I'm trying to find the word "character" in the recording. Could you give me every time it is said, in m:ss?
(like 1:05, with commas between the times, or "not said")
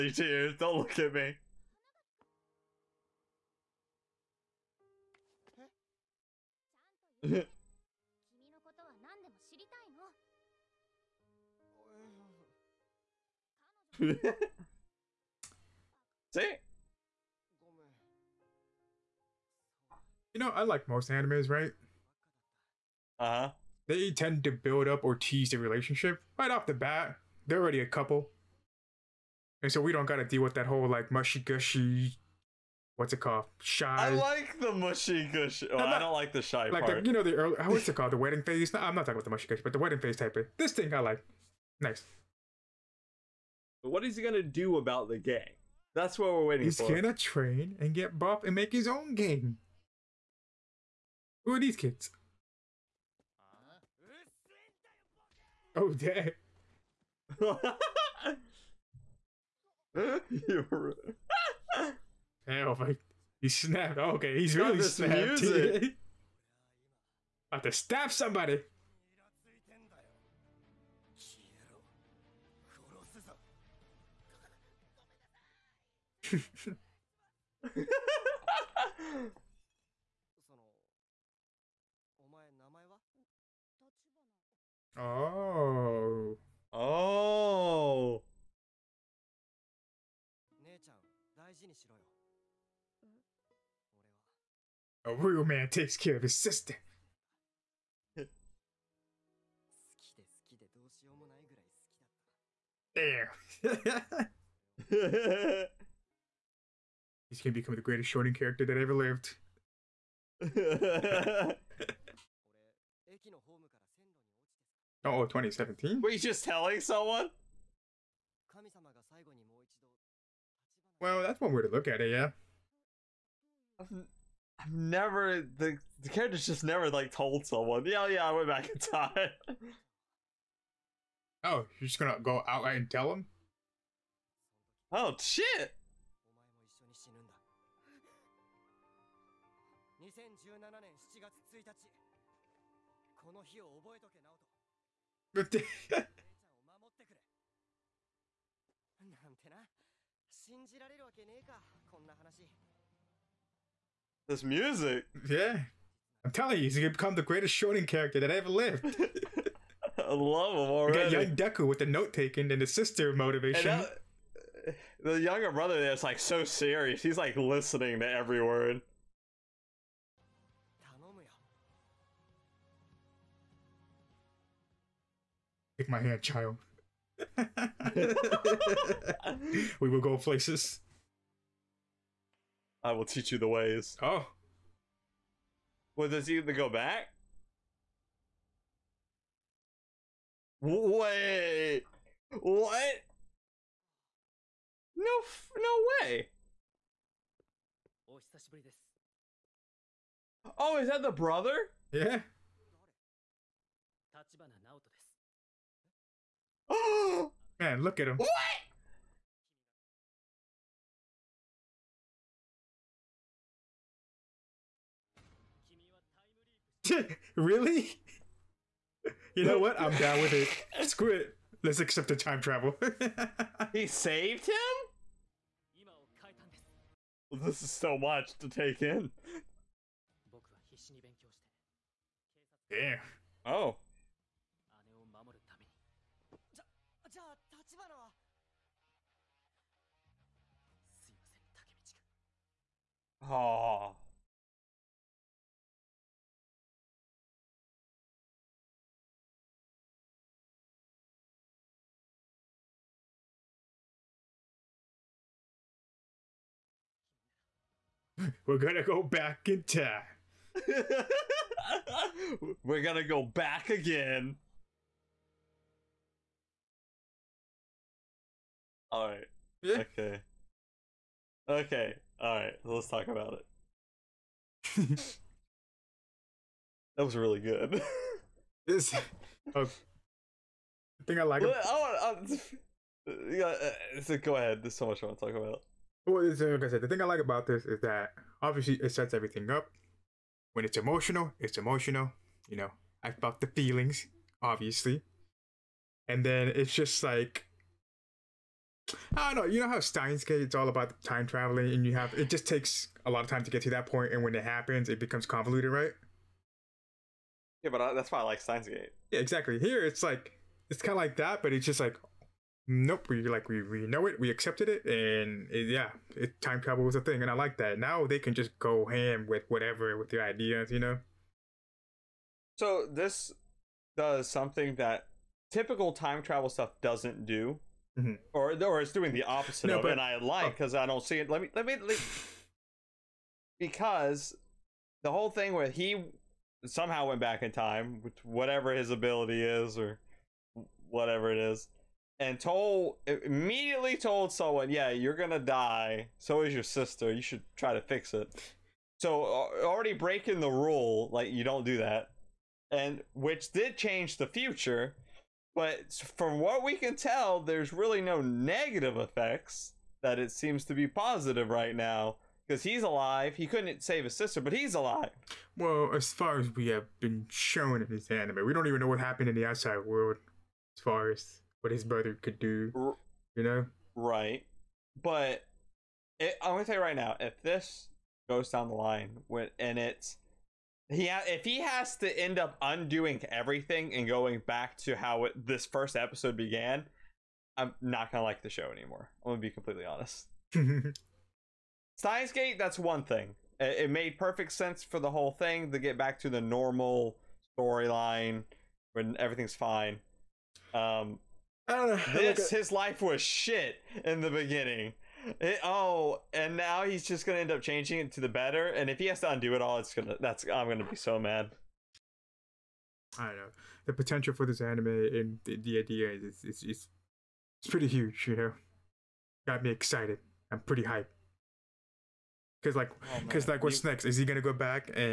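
1:48, 2:06, 2:37.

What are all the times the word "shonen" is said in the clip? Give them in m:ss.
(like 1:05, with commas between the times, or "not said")
1:48, 2:37.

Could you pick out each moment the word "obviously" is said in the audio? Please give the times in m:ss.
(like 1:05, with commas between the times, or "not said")
4:48, 4:54.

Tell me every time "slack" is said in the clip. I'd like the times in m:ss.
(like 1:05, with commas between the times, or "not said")
not said.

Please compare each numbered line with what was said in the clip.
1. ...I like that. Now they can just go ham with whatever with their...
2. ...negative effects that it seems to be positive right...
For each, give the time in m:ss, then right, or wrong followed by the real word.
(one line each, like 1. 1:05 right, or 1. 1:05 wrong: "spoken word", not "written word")
1. 5:17 right
2. 5:58 right.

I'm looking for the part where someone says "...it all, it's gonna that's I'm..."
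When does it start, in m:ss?
6:49.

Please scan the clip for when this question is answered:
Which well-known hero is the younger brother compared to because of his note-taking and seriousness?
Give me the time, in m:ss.
2:41.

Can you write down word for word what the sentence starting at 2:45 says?
the younger brother there's like so serious.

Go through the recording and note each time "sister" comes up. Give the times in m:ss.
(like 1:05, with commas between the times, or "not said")
1:36, 2:42, 5:46, 6:04.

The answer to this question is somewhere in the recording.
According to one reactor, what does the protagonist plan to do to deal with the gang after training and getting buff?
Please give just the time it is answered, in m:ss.
0:48.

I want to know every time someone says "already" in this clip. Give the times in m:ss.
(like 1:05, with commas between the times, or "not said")
0:27, 2:40, 5:49.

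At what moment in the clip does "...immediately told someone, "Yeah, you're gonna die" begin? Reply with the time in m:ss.
5:43.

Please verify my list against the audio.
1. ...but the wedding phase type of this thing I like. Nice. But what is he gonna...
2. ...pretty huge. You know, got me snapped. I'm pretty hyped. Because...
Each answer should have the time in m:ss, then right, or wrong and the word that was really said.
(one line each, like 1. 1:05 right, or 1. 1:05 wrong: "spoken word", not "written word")
1. 0:39 right
2. 6:57 wrong: "excited", not "snapped".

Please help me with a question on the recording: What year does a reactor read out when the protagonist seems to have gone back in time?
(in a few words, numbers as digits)
2017.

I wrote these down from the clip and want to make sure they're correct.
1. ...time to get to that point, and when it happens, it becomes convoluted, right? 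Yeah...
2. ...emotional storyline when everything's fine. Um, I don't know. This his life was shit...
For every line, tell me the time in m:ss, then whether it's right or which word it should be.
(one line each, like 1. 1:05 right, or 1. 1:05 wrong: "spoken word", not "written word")
1. 5:03 right
2. 6:36 wrong: "normal", not "emotional".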